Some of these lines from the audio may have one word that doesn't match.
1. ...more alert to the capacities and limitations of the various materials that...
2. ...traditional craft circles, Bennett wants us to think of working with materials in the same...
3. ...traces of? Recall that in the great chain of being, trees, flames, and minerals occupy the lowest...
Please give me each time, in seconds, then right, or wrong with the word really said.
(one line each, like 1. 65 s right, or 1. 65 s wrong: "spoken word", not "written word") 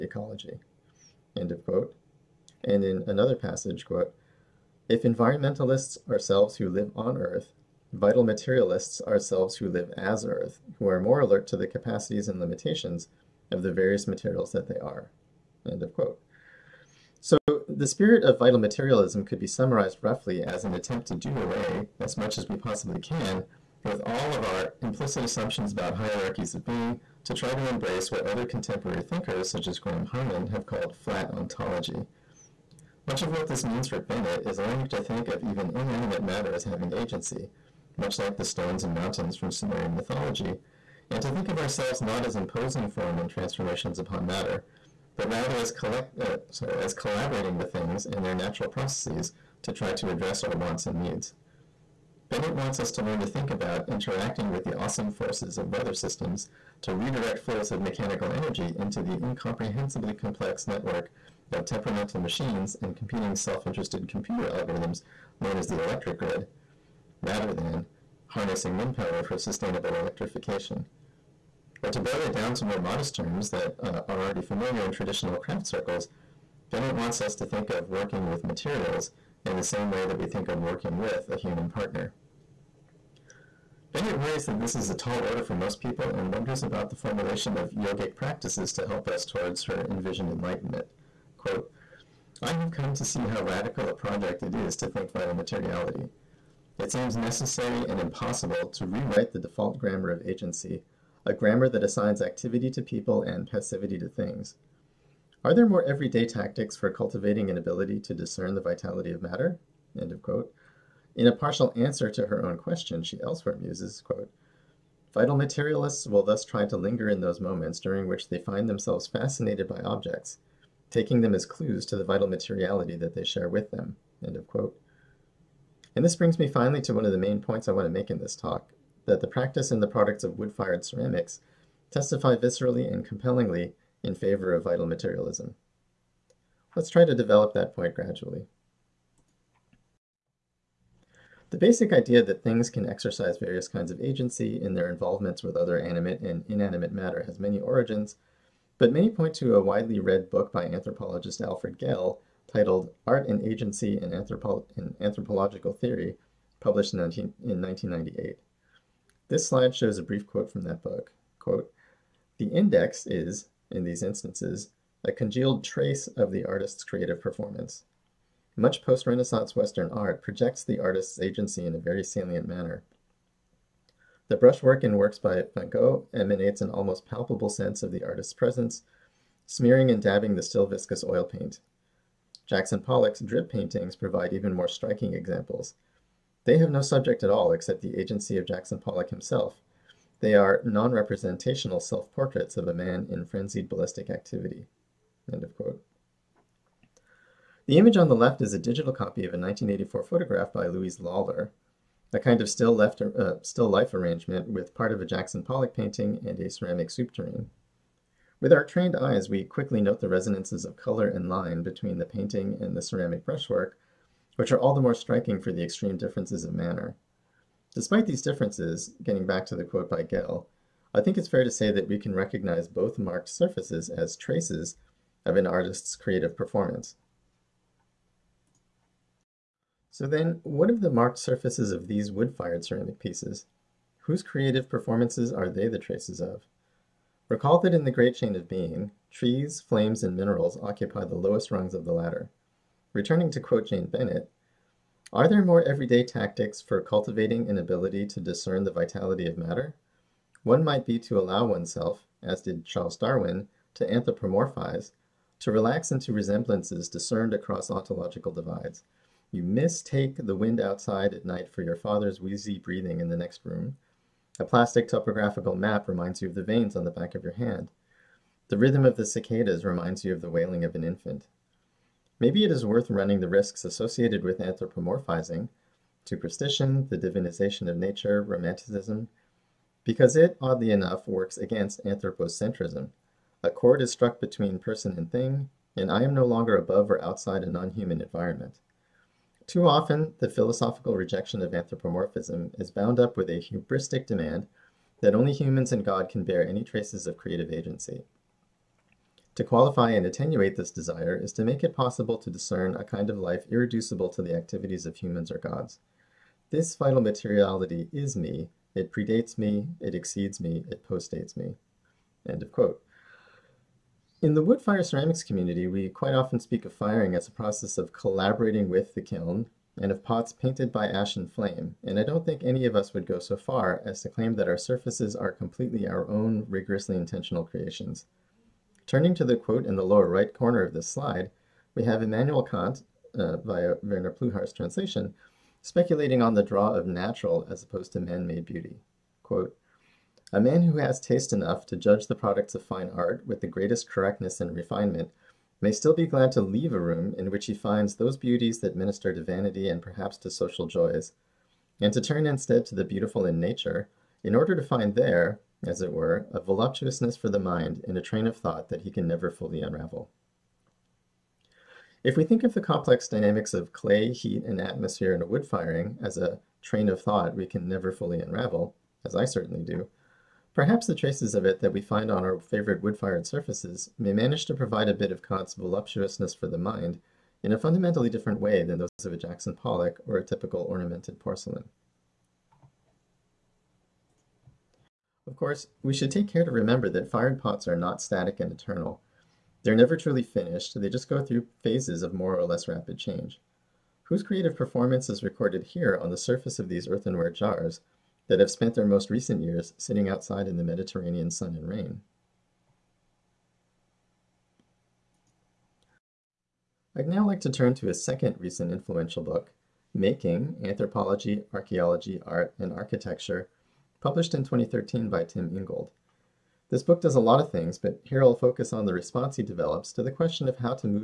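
1. 11 s right
2. 74 s right
3. 235 s right.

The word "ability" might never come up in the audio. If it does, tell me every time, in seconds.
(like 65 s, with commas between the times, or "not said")
107 s, 247 s.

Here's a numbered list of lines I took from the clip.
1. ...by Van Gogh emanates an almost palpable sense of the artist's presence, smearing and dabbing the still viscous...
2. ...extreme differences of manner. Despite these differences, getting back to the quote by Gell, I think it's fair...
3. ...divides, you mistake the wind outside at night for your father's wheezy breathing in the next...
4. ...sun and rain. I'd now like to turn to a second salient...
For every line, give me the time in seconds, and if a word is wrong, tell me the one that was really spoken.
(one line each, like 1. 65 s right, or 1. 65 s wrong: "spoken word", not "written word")
1. 175 s right
2. 215 s right
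3. 258 s right
4. 401 s wrong: "recent", not "salient".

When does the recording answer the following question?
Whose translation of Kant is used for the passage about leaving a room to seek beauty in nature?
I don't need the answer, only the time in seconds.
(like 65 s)
333 s.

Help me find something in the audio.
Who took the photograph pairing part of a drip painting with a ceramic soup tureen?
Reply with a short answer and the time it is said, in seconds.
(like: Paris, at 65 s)
Louise Lawler, at 200 s.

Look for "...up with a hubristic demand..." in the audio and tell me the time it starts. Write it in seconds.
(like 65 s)
293 s.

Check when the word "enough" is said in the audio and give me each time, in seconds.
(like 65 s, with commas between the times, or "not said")
280 s, 341 s.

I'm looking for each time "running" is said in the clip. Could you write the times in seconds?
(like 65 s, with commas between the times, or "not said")
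272 s.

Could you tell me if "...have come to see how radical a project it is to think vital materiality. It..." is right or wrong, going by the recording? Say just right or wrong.
right.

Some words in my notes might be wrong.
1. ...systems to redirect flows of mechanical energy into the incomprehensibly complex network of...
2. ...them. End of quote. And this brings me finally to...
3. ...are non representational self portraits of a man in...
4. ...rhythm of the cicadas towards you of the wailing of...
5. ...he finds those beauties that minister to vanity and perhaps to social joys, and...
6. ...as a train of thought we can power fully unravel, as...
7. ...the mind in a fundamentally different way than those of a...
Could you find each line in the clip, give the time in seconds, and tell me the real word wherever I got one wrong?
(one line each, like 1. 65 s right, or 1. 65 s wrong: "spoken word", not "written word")
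1. 55 s right
2. 123 s right
3. 190 s right
4. 268 s wrong: "reminds", not "towards"
5. 347 s right
6. 366 s wrong: "never", not "power"
7. 376 s right.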